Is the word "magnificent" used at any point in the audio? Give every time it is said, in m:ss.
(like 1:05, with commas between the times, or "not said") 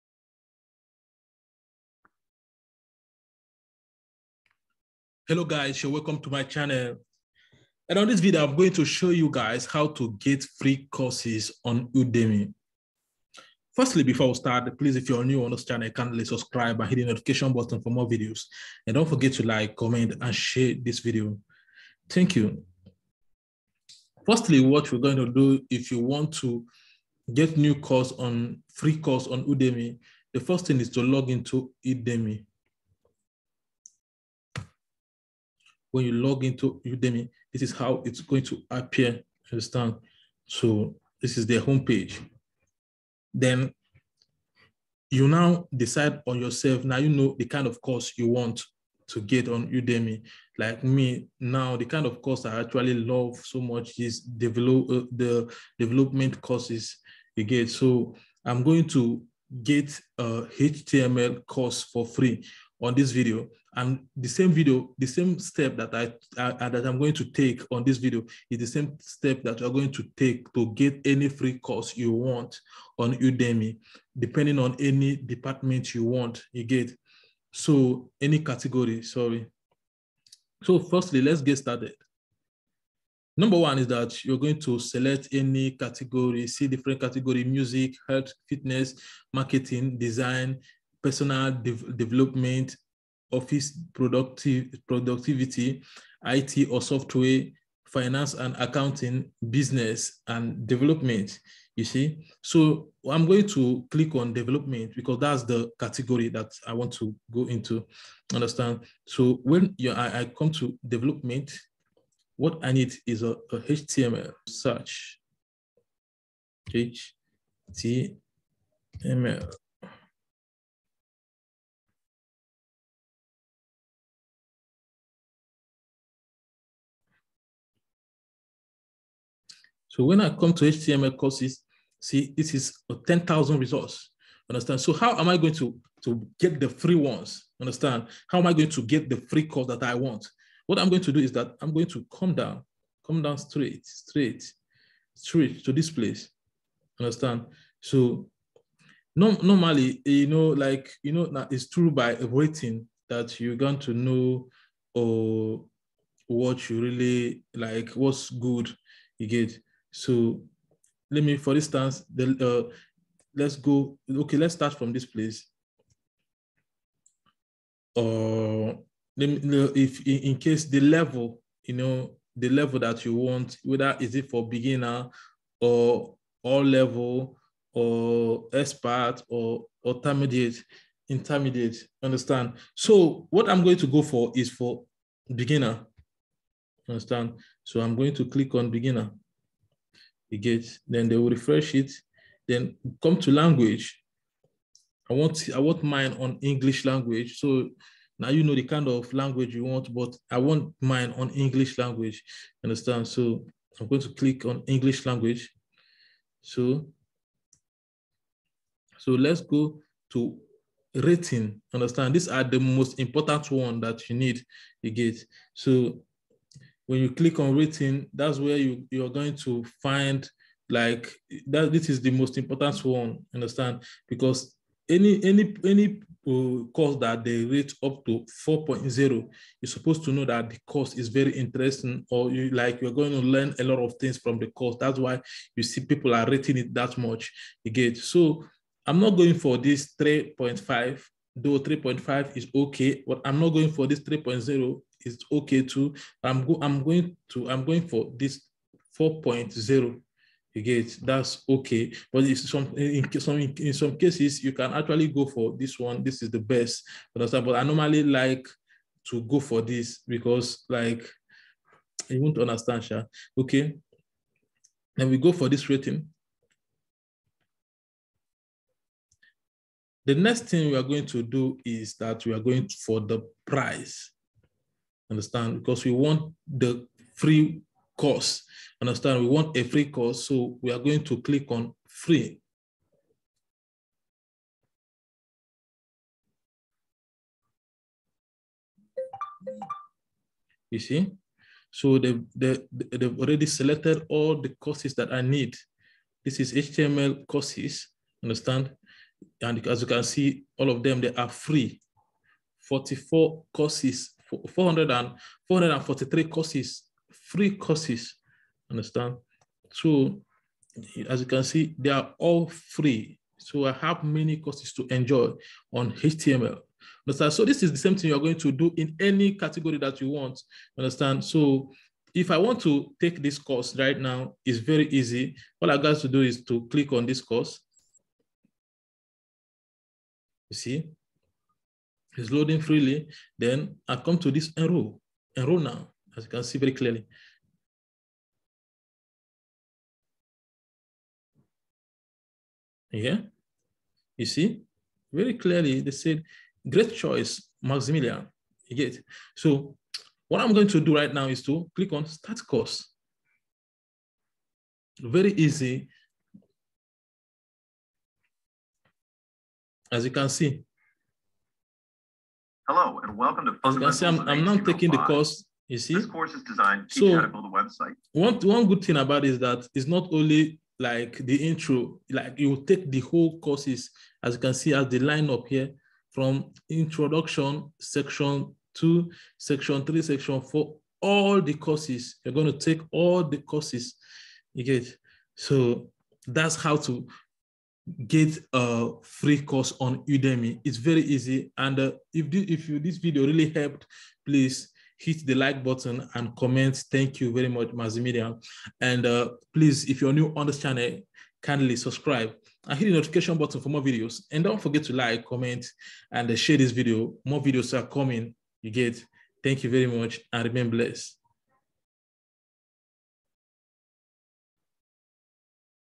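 not said.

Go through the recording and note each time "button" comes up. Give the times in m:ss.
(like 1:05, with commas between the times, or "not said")
0:17, 6:35, 6:43.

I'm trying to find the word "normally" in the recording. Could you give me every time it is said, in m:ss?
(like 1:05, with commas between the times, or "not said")
2:29, 4:17.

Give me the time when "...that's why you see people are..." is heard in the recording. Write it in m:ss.
3:54.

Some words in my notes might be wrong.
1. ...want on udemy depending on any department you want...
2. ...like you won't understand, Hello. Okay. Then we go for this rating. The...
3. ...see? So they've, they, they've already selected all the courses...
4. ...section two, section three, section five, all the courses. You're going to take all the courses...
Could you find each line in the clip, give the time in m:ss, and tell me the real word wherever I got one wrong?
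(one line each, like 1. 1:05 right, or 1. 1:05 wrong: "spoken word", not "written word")
1. 1:12 right
2. 4:20 wrong: "Sha", not "Hello"
3. 4:50 right
4. 6:17 wrong: "four", not "five".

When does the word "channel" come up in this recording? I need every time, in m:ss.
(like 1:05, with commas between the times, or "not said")
0:06, 0:15, 6:40.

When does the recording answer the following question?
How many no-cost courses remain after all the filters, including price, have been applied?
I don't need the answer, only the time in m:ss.
5:05.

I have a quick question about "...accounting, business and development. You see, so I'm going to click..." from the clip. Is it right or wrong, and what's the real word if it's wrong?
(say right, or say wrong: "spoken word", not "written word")
right.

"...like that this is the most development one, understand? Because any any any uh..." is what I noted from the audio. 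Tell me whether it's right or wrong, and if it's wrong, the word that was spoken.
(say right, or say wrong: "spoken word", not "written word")
wrong: "important", not "development".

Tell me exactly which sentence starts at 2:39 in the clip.
So let me, for instance, the, uh, let's go, okay, let's start from this place.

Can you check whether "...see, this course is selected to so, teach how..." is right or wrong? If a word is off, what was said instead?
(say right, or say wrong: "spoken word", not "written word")
wrong: "designed", not "selected".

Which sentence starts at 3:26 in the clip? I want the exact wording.
So, so let's go to rating.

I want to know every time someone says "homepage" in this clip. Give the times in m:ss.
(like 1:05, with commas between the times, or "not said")
0:41.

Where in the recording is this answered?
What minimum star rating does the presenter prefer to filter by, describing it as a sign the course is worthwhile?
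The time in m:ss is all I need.
4:07.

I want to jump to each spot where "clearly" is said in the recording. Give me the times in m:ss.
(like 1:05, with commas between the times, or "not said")
5:36, 5:45.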